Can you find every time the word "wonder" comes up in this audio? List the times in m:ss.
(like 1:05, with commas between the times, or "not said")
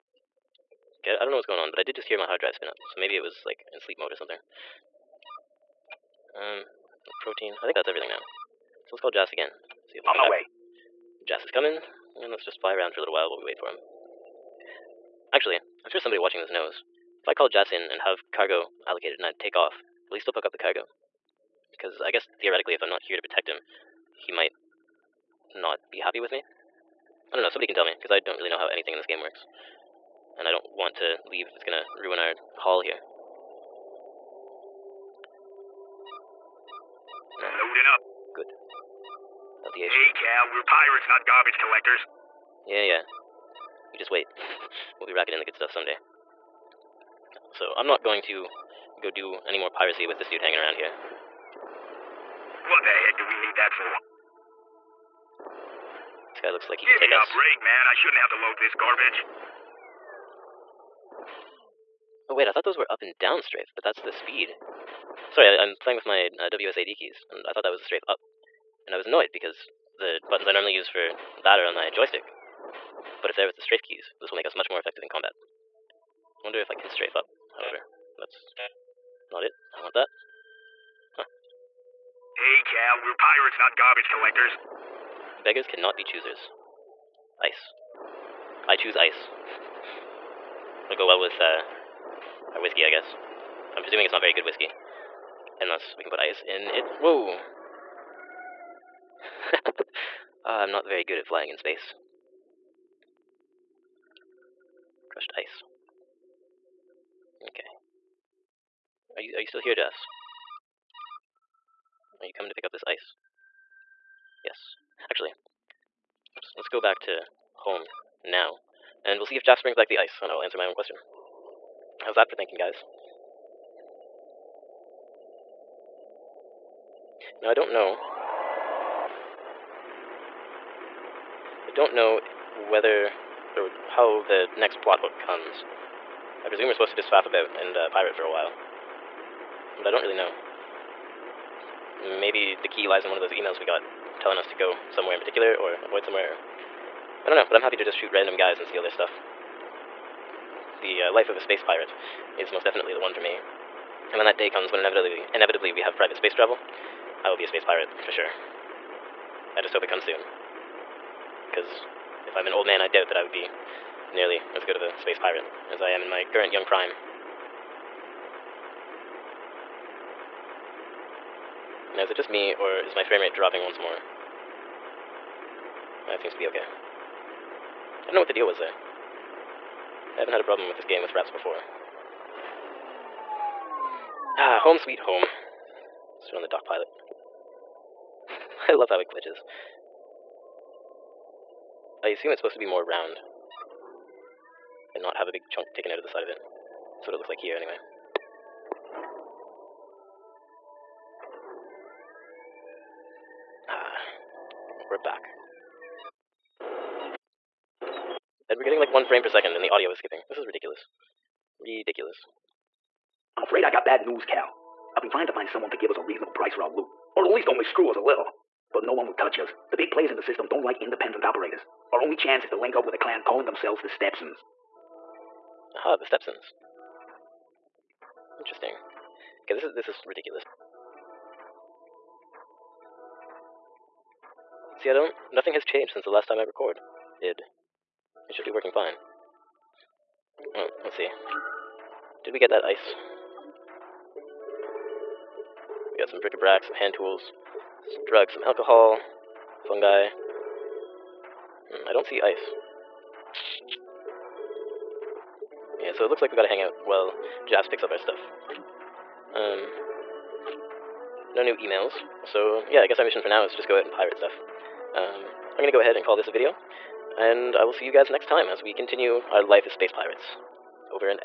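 1:16.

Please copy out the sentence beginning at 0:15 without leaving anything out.
Actually, I'm sure somebody watching this knows.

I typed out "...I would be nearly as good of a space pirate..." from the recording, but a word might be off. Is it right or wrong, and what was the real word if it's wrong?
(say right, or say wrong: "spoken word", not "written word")
right.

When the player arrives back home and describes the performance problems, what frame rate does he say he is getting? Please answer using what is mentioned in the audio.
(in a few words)
1 frame per second.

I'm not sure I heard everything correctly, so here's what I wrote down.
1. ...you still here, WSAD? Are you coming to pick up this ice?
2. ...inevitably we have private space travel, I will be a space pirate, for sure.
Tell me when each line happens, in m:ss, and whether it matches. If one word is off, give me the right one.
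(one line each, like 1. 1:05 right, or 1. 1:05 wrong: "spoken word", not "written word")
1. 1:49 wrong: "Jafs", not "WSAD"
2. 2:35 right.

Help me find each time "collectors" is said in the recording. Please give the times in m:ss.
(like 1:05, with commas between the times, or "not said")
0:41, 1:24.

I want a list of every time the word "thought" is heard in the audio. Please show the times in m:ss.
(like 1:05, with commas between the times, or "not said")
1:02, 1:07.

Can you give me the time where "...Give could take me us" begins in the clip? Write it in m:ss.
0:56.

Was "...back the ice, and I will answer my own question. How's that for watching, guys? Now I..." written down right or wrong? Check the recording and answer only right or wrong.
wrong.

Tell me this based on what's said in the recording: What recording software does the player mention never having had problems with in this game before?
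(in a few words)
Fraps.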